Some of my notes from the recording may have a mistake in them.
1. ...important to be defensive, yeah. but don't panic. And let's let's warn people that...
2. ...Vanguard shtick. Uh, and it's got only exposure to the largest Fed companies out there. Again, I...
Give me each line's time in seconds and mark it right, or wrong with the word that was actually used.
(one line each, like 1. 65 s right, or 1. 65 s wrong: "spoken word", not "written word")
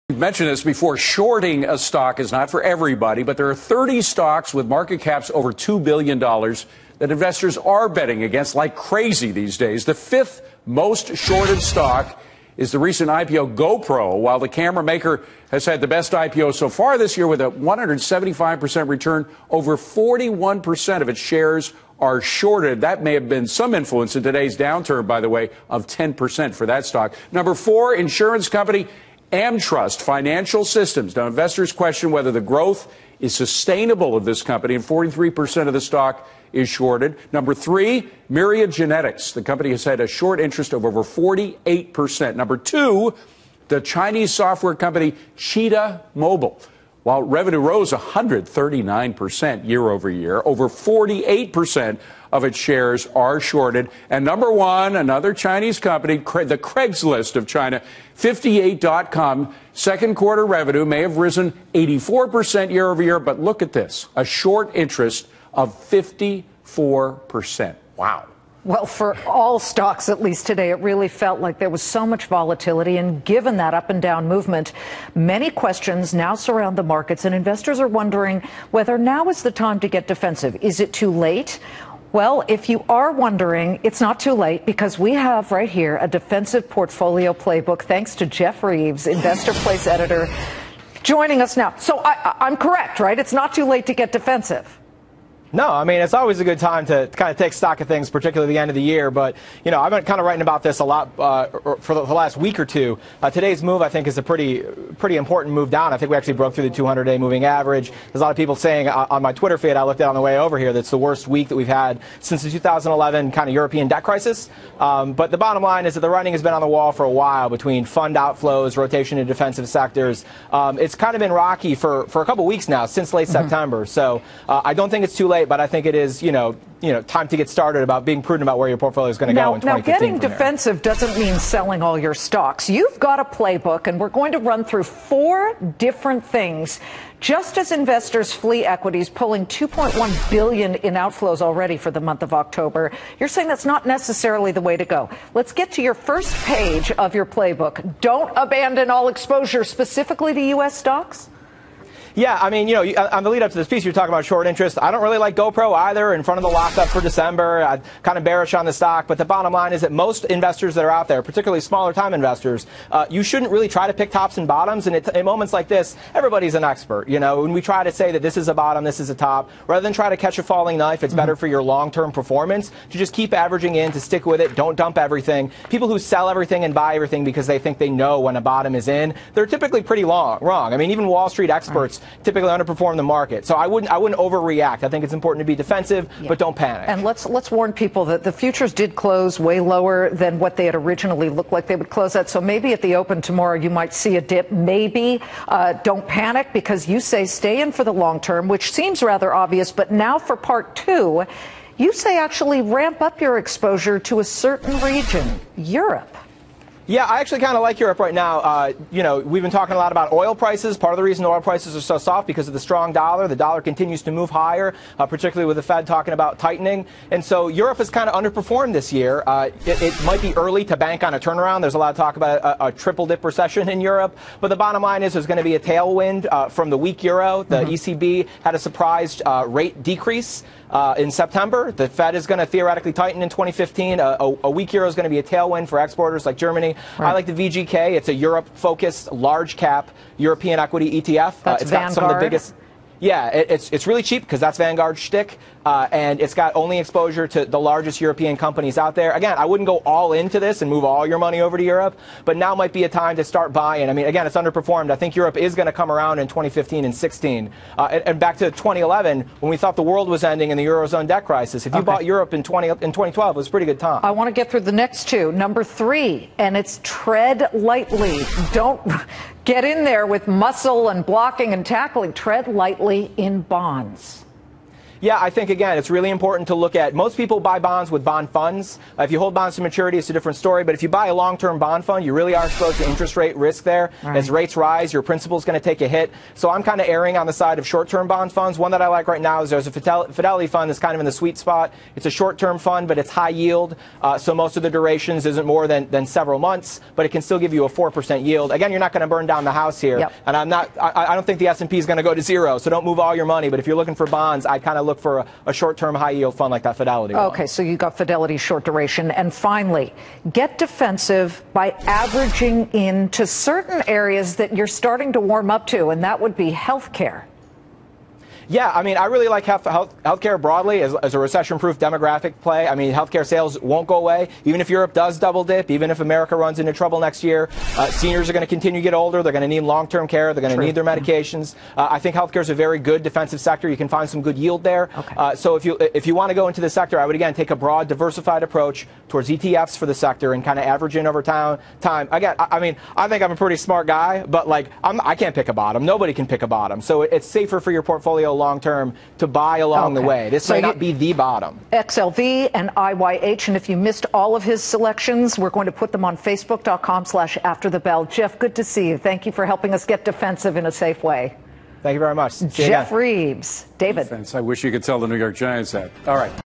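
1. 185 s right
2. 244 s wrong: "European", not "Fed".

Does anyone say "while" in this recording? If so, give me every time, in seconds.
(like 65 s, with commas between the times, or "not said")
14 s, 47 s, 117 s.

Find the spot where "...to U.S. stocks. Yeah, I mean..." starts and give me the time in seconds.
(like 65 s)
150 s.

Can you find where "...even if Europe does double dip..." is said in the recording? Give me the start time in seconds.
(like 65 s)
324 s.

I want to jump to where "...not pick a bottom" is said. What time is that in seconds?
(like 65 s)
345 s.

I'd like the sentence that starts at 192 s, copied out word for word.
So maybe at the open tomorrow you might see a dip.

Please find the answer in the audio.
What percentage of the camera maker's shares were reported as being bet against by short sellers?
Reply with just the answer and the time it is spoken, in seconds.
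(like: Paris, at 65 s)
41%, at 19 s.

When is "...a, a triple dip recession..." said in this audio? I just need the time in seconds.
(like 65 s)
222 s.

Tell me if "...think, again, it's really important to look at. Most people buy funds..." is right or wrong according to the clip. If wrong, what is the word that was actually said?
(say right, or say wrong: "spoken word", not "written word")
wrong: "bonds", not "funds".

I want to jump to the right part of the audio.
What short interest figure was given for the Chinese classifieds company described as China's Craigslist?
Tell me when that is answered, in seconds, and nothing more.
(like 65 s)
65 s.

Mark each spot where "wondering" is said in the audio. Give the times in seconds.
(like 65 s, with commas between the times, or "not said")
77 s, 83 s.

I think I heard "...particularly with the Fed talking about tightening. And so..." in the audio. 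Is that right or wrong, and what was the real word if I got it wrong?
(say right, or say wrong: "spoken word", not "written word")
right.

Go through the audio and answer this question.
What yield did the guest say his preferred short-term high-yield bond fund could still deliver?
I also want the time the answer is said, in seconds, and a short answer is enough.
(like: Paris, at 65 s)
4%, at 297 s.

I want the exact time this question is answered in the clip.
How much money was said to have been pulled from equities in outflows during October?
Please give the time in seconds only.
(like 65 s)
139 s.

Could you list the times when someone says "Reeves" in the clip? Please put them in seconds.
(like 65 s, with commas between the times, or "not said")
88 s, 362 s.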